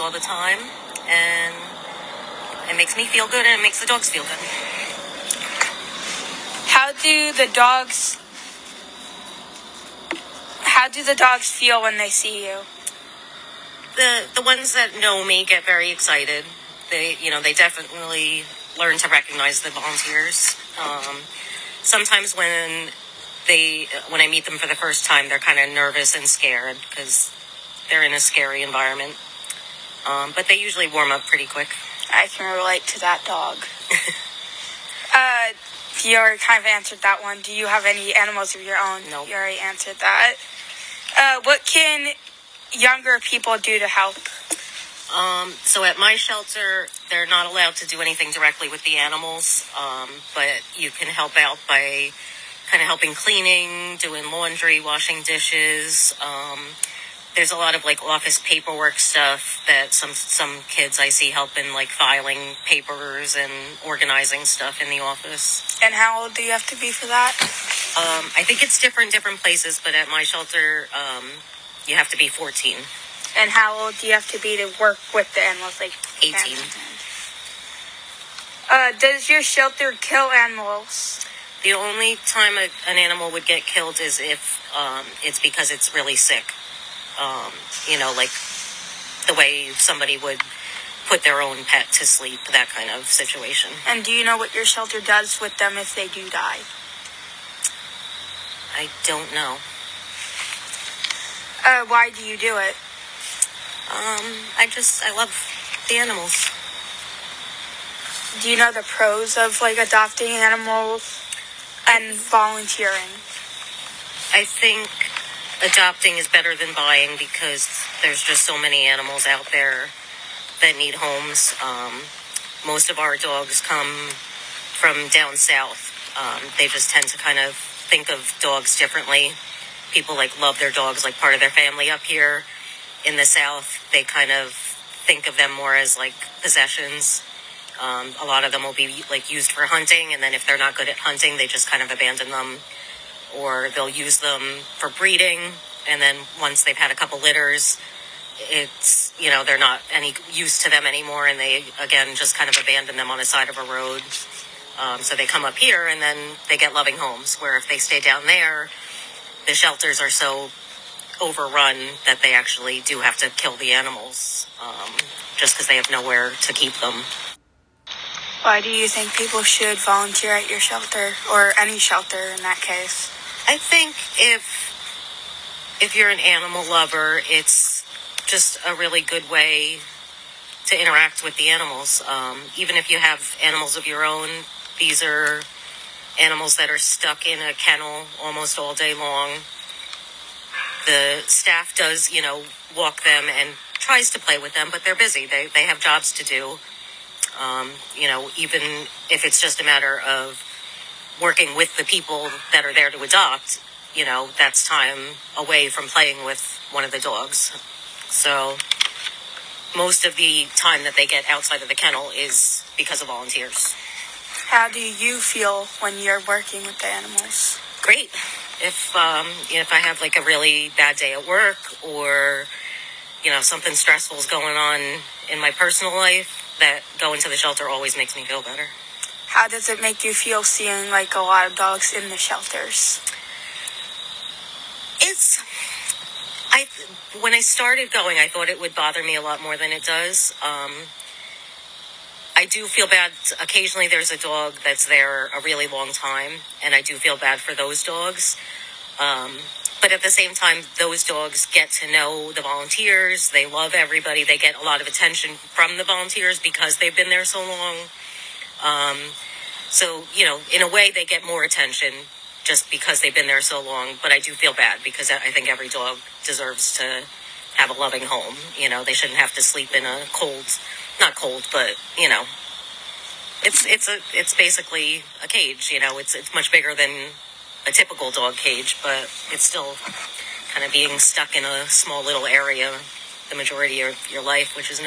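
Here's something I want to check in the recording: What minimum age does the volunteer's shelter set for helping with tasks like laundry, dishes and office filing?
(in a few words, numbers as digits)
14.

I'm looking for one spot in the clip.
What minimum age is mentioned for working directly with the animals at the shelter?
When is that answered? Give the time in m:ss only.
1:15.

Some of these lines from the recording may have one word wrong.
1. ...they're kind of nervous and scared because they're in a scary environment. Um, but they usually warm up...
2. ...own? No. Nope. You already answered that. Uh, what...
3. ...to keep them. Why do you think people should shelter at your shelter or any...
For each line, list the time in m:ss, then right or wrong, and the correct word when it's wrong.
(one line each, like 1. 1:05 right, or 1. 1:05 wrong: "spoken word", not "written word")
1. 0:25 right
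2. 0:38 right
3. 2:46 wrong: "volunteer", not "shelter".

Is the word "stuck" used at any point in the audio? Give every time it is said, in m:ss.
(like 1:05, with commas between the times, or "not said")
3:06, 4:40.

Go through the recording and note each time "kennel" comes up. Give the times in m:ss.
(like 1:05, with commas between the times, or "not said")
3:07, 3:31.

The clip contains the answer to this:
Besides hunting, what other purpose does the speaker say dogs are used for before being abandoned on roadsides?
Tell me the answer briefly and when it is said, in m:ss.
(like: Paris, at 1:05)
breeding, at 2:23.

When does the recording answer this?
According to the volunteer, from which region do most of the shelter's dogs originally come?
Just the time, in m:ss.
2:05.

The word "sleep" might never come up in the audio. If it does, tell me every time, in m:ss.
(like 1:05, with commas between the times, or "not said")
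1:32, 4:29.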